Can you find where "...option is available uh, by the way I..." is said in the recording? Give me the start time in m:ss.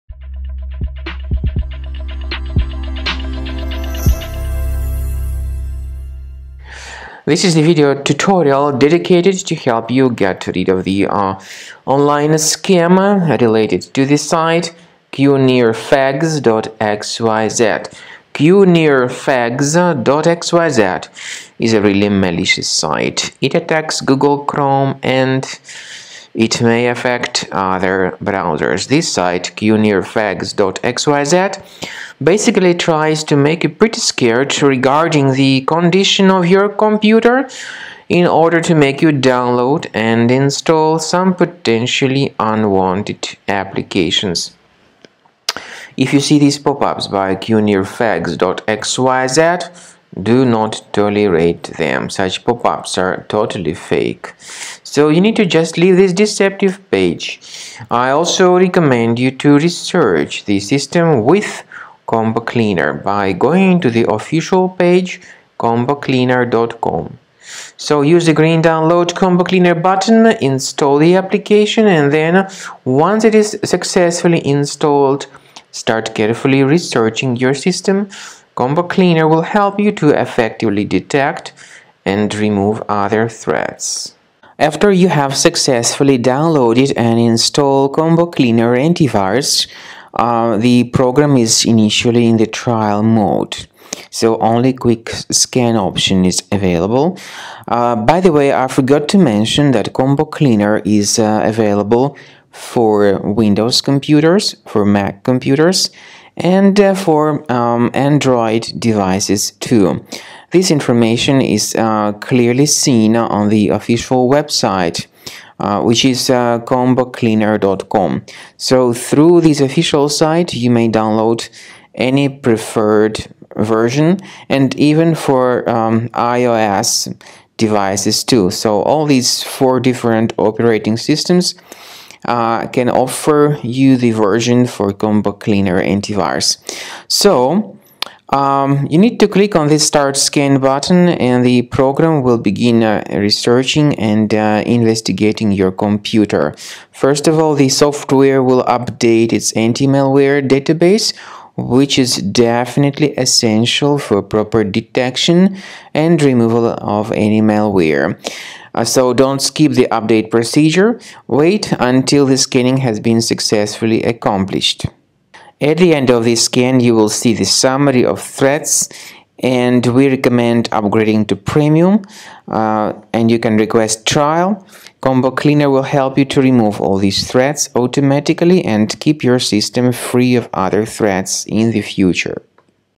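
1:35.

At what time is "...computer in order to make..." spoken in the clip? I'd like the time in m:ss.
0:36.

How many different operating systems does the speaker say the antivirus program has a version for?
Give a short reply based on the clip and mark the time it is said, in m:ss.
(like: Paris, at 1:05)
4, at 2:09.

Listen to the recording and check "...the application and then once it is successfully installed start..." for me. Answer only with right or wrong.
right.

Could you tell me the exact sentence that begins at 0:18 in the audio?
qnirfags.xyz is a really malicious site.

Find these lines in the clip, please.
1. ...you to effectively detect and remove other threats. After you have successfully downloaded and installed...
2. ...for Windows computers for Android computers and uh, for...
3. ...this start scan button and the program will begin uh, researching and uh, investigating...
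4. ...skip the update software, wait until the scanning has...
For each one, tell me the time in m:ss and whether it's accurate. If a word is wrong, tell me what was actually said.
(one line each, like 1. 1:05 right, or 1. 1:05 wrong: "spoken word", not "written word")
1. 1:19 right
2. 1:42 wrong: "Mac", not "Android"
3. 2:19 right
4. 2:39 wrong: "procedure", not "software".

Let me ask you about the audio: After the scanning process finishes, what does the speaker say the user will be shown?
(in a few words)
Summary of threats.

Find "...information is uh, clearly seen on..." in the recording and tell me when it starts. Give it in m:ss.
1:50.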